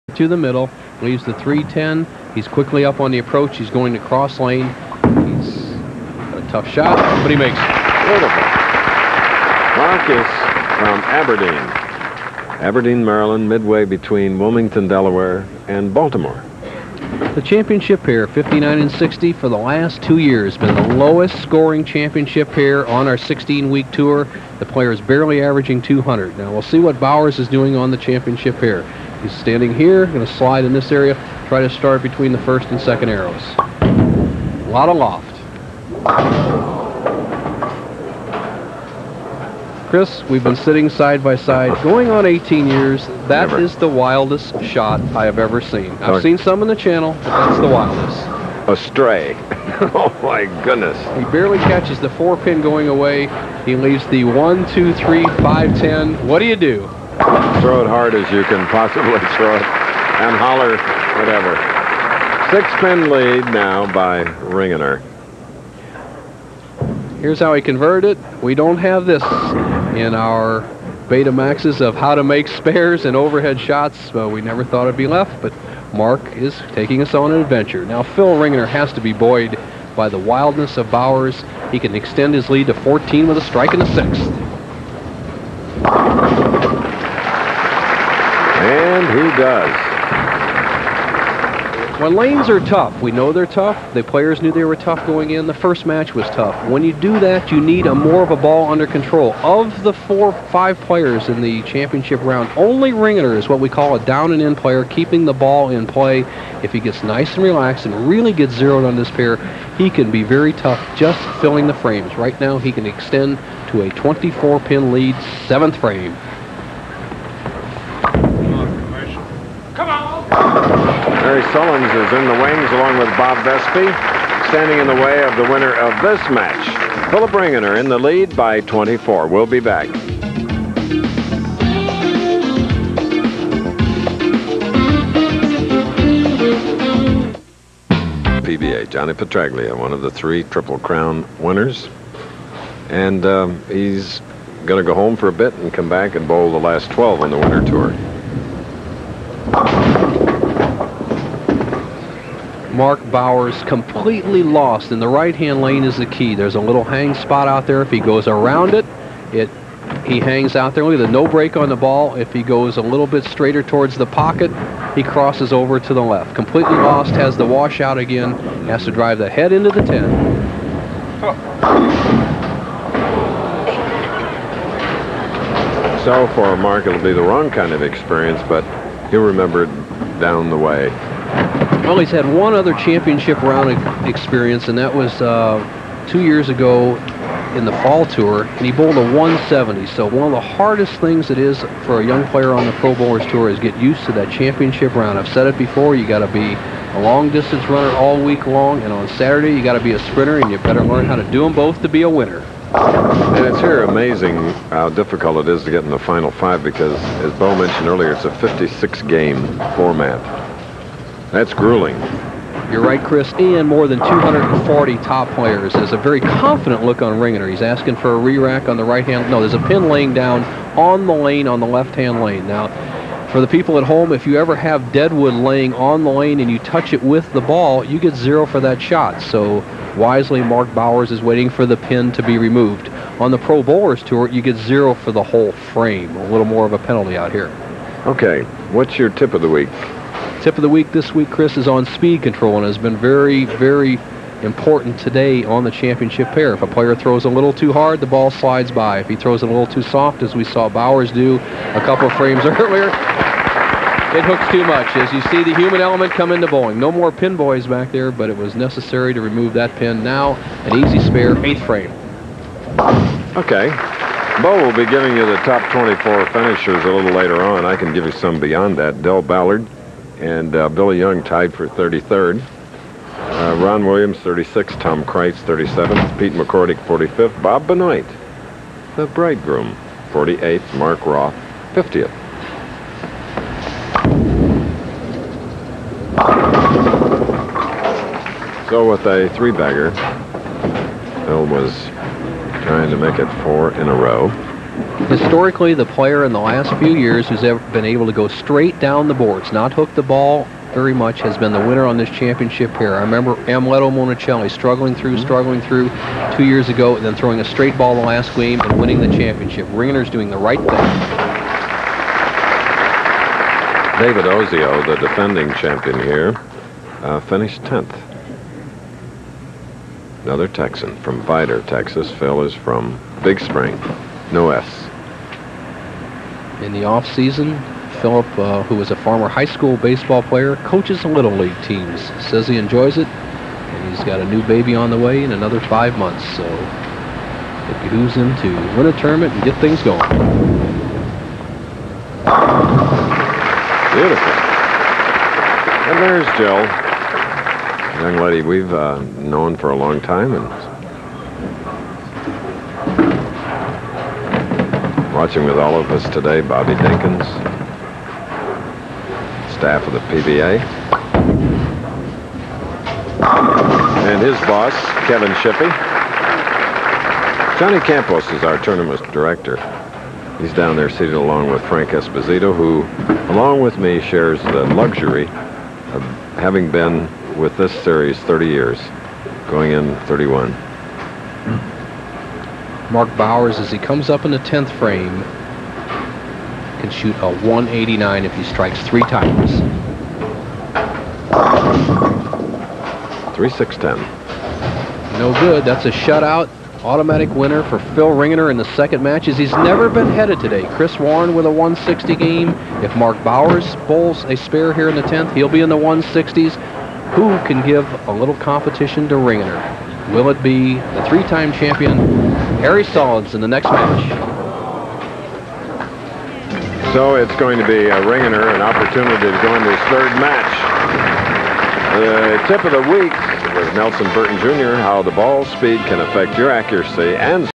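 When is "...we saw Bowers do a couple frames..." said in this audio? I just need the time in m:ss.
4:10.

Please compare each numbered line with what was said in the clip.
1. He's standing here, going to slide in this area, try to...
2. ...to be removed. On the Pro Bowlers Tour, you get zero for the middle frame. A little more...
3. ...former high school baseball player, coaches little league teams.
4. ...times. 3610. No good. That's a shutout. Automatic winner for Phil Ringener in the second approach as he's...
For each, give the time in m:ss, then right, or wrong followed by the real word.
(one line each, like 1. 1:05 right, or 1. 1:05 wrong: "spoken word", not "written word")
1. 0:29 right
2. 3:52 wrong: "whole", not "middle"
3. 5:28 right
4. 6:29 wrong: "match", not "approach".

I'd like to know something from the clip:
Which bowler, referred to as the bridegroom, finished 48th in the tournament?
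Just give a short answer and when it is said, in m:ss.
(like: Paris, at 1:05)
Bob Benoit, at 4:37.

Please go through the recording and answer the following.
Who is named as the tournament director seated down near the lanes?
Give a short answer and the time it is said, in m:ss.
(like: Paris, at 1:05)
Johnny Campos, at 6:07.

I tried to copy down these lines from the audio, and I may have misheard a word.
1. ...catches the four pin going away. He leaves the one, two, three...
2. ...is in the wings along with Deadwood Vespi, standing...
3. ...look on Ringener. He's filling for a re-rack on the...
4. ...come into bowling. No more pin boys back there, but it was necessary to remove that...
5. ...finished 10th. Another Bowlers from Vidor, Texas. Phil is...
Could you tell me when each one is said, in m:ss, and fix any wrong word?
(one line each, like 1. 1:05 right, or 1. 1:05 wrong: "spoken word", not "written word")
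1. 0:51 right
2. 2:01 wrong: "Bob", not "Deadwood"
3. 3:36 wrong: "asking", not "filling"
4. 4:16 right
5. 5:17 wrong: "Texan", not "Bowlers".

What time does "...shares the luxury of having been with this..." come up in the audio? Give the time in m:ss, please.
6:14.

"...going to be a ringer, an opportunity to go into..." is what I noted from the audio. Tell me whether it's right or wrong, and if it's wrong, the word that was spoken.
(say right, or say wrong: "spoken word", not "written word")
right.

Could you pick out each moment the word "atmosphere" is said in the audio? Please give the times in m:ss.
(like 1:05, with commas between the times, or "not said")
not said.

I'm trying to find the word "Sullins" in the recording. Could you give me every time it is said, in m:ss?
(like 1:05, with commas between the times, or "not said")
2:01, 6:52.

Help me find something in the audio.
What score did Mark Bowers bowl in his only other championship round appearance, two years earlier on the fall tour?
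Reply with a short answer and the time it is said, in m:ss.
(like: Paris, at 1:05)
170, at 3:08.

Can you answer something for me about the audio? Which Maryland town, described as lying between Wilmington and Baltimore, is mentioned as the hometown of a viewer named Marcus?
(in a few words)
Aberdeen.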